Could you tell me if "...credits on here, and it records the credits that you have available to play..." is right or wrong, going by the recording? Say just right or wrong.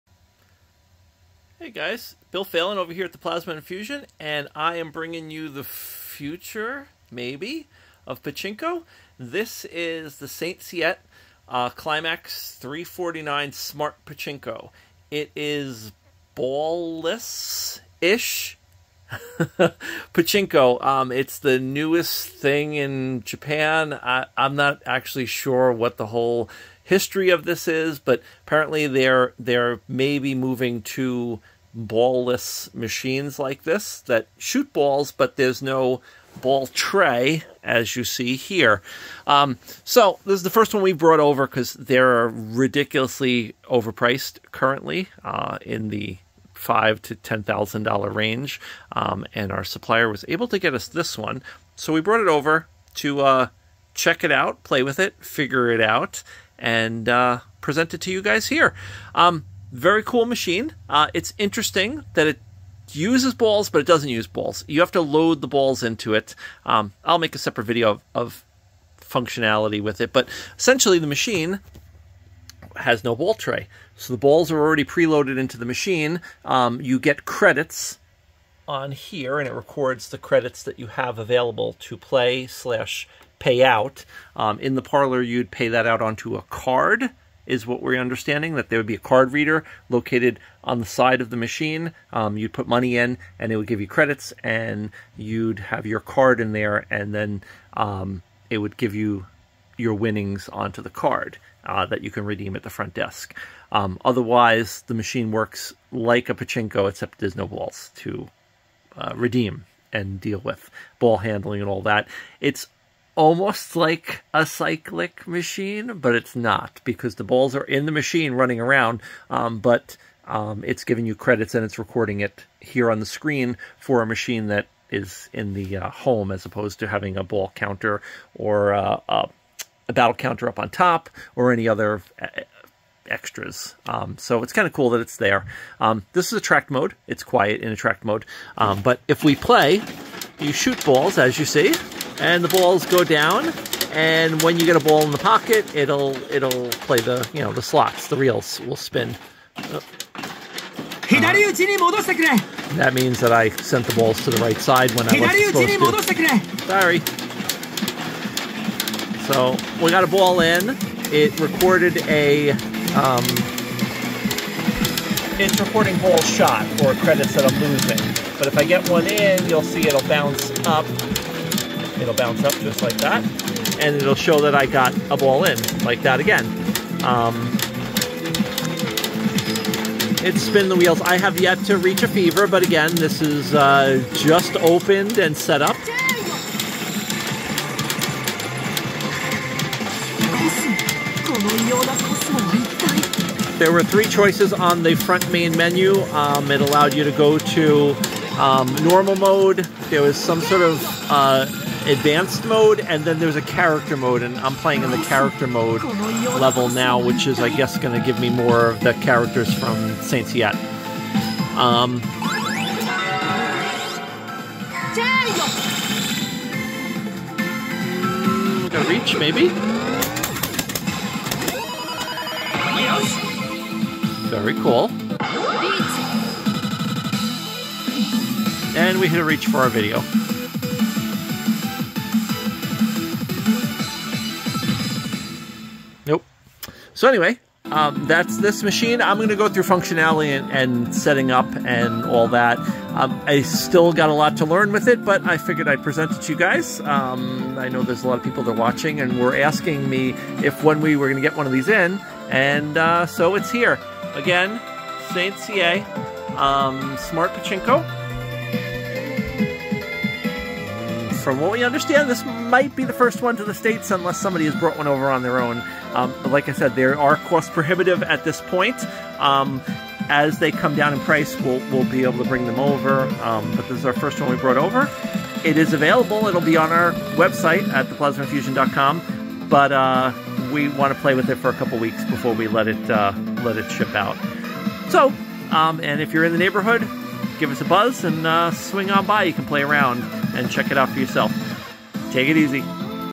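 right.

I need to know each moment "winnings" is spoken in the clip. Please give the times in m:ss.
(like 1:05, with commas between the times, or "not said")
1:39.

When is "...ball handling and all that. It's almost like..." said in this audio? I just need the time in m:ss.
1:50.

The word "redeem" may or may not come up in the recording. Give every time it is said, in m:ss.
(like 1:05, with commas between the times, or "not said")
1:42, 1:49.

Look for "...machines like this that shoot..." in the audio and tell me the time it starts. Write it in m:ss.
0:32.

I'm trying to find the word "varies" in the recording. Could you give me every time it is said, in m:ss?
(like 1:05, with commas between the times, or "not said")
not said.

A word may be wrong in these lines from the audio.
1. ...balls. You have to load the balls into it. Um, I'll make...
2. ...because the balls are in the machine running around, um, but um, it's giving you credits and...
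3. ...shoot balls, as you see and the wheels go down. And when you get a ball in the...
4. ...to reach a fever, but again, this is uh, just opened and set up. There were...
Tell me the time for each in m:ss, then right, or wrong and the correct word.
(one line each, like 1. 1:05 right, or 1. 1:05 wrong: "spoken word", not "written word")
1. 1:04 right
2. 1:56 right
3. 2:20 wrong: "balls", not "wheels"
4. 3:01 right.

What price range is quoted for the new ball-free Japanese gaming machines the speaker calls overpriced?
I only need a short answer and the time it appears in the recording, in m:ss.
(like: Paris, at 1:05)
$5,000 to $10,000, at 0:46.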